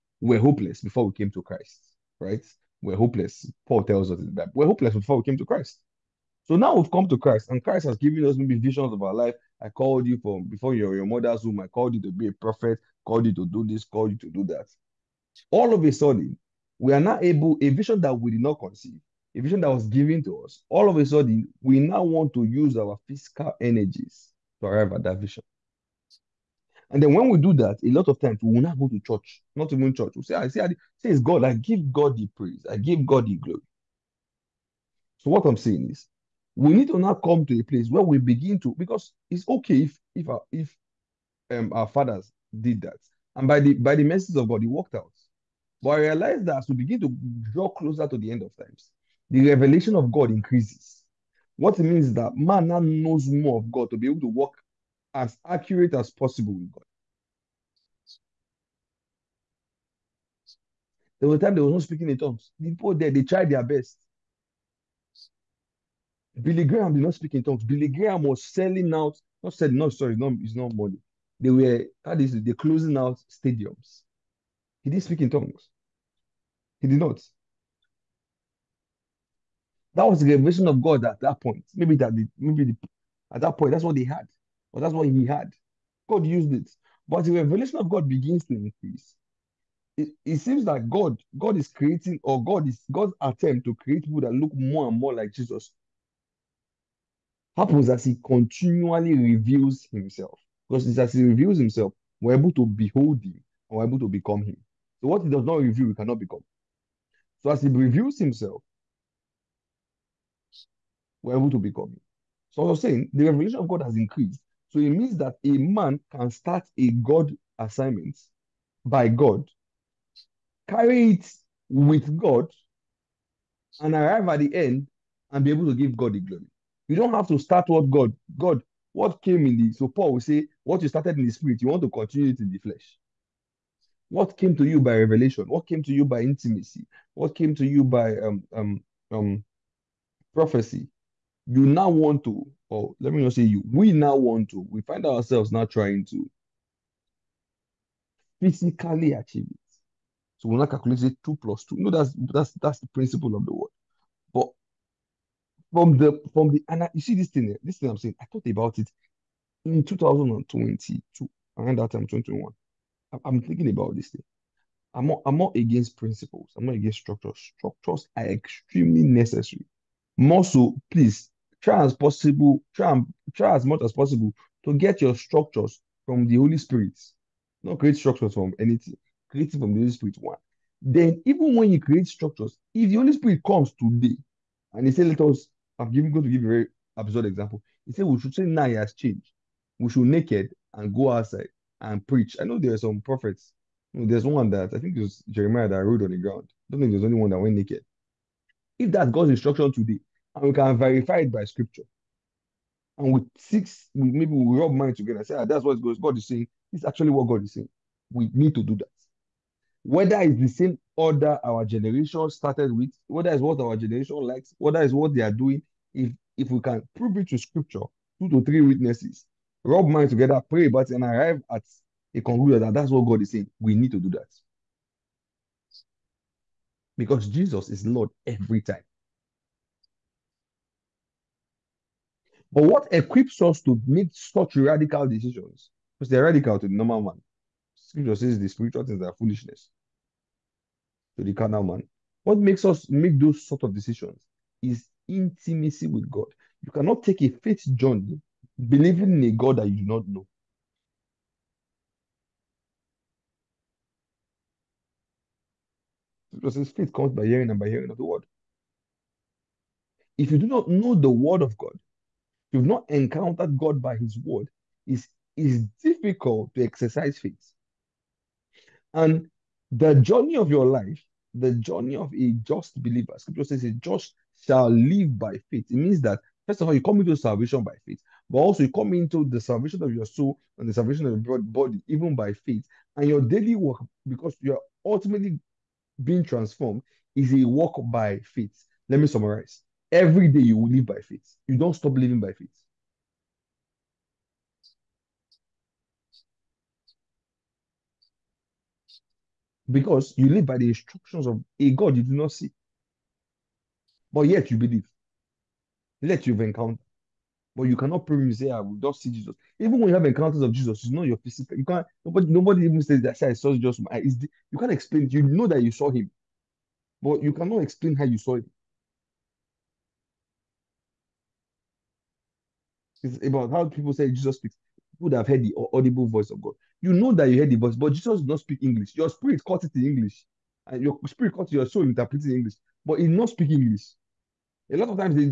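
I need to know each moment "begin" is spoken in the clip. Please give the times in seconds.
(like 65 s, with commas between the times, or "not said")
38 s, 46 s, 88 s.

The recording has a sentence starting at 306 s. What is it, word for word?
Let you have encountered, But you cannot prove.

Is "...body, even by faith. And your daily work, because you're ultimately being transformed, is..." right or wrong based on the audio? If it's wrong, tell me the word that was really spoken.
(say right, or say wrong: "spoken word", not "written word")
right.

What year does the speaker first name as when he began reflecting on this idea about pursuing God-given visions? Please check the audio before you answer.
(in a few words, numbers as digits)
2022.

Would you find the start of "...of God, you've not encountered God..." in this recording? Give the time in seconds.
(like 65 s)
261 s.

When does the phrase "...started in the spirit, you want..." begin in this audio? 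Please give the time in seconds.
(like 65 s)
130 s.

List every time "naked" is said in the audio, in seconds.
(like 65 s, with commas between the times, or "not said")
190 s, 197 s.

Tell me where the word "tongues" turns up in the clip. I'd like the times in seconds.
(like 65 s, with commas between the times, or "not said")
62 s, 67 s, 75 s.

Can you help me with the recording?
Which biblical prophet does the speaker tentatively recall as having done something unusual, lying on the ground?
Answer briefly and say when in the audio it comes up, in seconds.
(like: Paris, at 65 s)
Jeremiah, at 195 s.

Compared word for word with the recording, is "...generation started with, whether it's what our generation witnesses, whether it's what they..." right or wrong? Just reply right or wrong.
wrong.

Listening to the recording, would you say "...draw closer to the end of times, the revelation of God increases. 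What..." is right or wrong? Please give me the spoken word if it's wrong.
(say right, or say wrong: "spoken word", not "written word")
right.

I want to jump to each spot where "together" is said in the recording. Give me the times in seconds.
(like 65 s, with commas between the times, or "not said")
204 s, 220 s.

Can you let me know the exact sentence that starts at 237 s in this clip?
Scripture says the spiritual things are foolishness to the carnal man.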